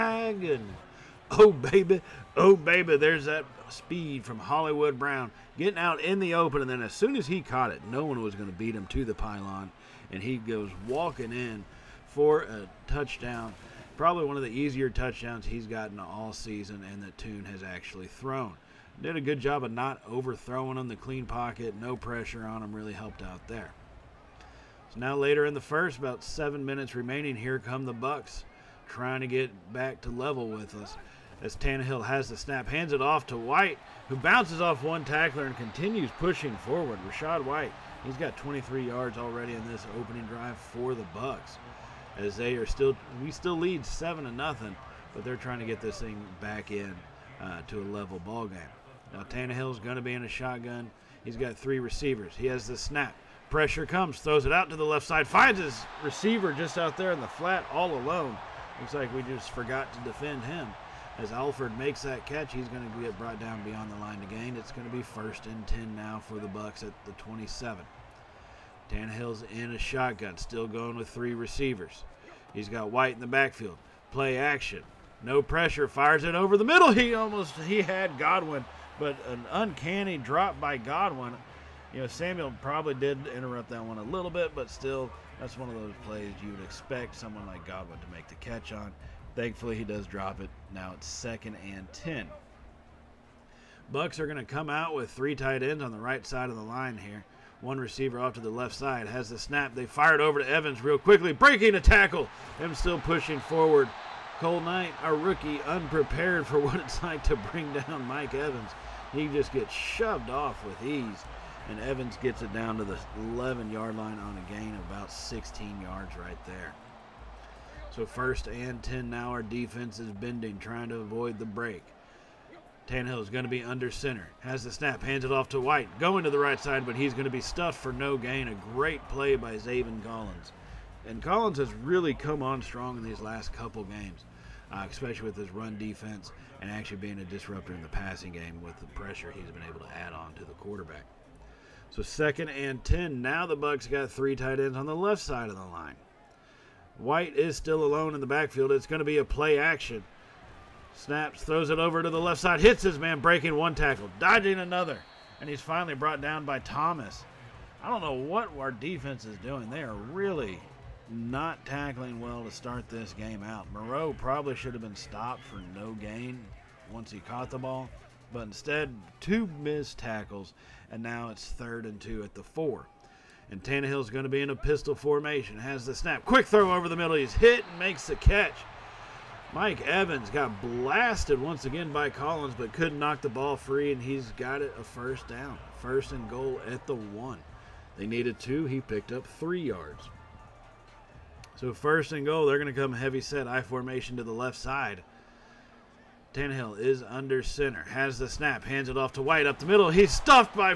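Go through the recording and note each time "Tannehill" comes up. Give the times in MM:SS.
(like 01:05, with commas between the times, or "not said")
00:31, 00:49, 01:08, 02:02, 02:53, 03:16.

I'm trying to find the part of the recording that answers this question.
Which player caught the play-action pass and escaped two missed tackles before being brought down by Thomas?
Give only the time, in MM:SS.
02:43.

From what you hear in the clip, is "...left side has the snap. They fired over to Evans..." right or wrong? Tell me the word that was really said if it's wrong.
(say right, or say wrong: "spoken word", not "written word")
right.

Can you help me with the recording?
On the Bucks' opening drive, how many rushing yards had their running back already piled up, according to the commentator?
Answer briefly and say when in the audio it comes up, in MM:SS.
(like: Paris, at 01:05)
23, at 00:38.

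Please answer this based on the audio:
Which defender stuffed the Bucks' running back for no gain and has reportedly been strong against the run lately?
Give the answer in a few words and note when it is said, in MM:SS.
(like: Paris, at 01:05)
Zaven Collins, at 02:09.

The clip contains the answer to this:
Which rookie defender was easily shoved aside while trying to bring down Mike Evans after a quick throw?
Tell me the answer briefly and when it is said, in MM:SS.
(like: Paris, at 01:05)
Cole Knight, at 01:44.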